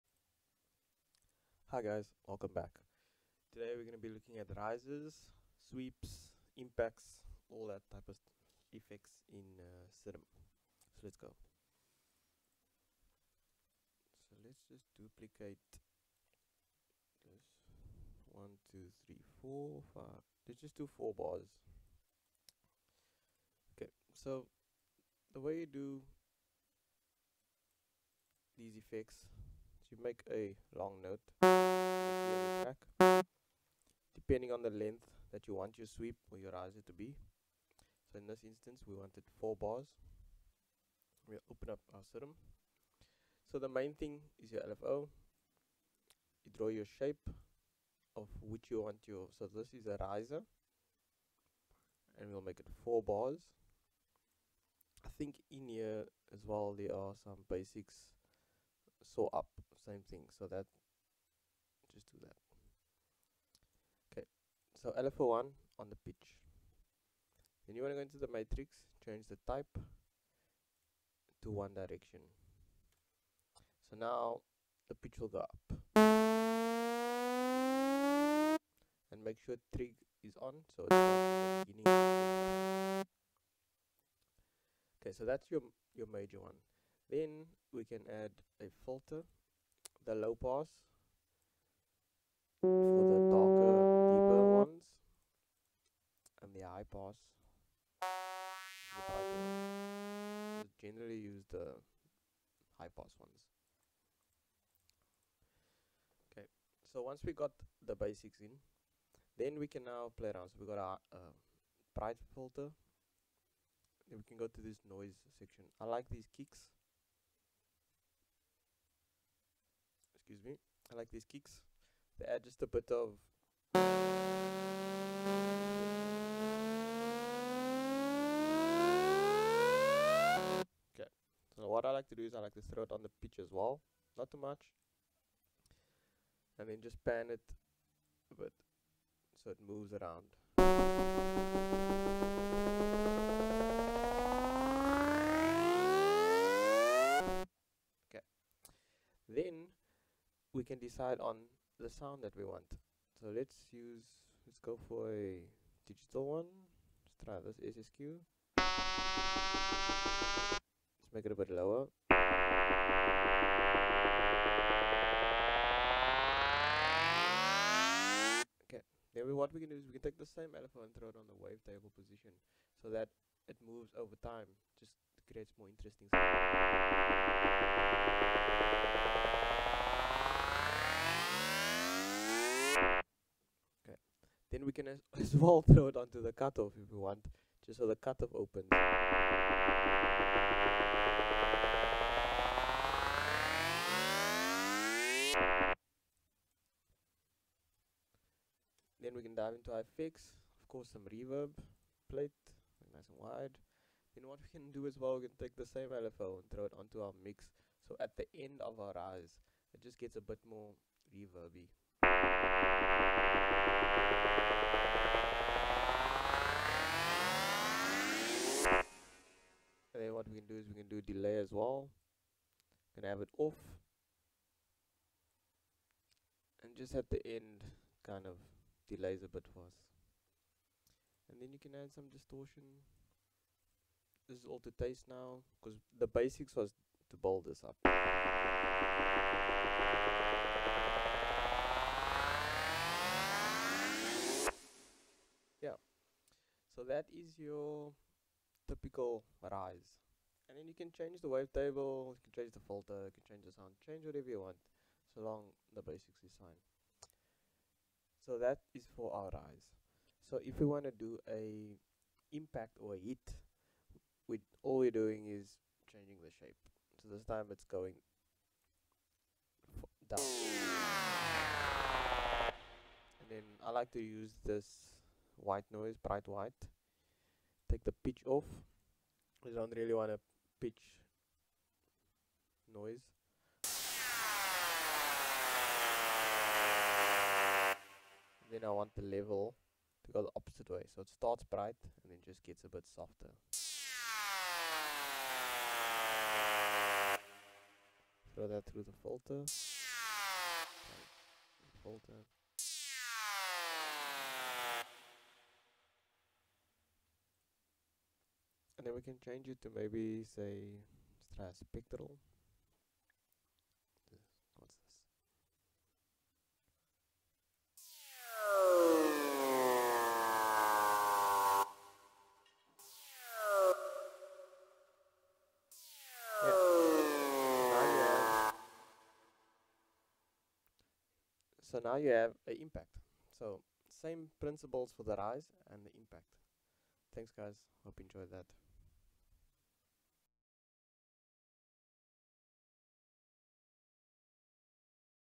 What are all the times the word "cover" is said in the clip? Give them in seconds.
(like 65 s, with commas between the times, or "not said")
not said.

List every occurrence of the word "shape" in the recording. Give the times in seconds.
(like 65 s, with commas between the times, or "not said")
46 s, 266 s.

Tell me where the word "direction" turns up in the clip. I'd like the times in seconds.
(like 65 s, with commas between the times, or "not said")
71 s.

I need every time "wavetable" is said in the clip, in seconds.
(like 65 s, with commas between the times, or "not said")
171 s, 251 s.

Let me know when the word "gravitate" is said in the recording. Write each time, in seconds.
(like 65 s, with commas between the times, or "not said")
not said.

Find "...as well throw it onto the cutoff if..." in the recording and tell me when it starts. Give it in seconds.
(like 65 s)
185 s.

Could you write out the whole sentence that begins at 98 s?
The generally use the high pass ones.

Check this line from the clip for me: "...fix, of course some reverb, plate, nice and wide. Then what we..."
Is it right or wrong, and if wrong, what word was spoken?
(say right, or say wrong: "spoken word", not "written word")
right.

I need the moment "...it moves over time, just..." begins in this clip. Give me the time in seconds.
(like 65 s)
173 s.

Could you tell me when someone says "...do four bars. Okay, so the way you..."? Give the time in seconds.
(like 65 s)
20 s.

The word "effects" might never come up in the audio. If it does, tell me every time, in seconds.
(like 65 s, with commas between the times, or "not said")
8 s, 28 s.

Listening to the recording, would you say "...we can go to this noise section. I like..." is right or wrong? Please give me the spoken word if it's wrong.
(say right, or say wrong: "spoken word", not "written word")
right.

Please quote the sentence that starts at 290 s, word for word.
So it starts bright and then just gets a bit softer.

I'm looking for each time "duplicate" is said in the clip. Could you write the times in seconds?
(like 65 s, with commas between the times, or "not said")
14 s.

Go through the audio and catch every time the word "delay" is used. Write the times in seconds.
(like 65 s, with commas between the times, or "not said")
221 s, 228 s.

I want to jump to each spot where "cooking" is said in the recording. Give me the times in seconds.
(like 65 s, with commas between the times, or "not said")
not said.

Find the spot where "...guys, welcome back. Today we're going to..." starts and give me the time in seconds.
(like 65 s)
1 s.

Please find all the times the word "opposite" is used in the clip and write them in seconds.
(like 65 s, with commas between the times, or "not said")
290 s.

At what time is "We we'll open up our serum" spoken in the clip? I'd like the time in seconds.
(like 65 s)
41 s.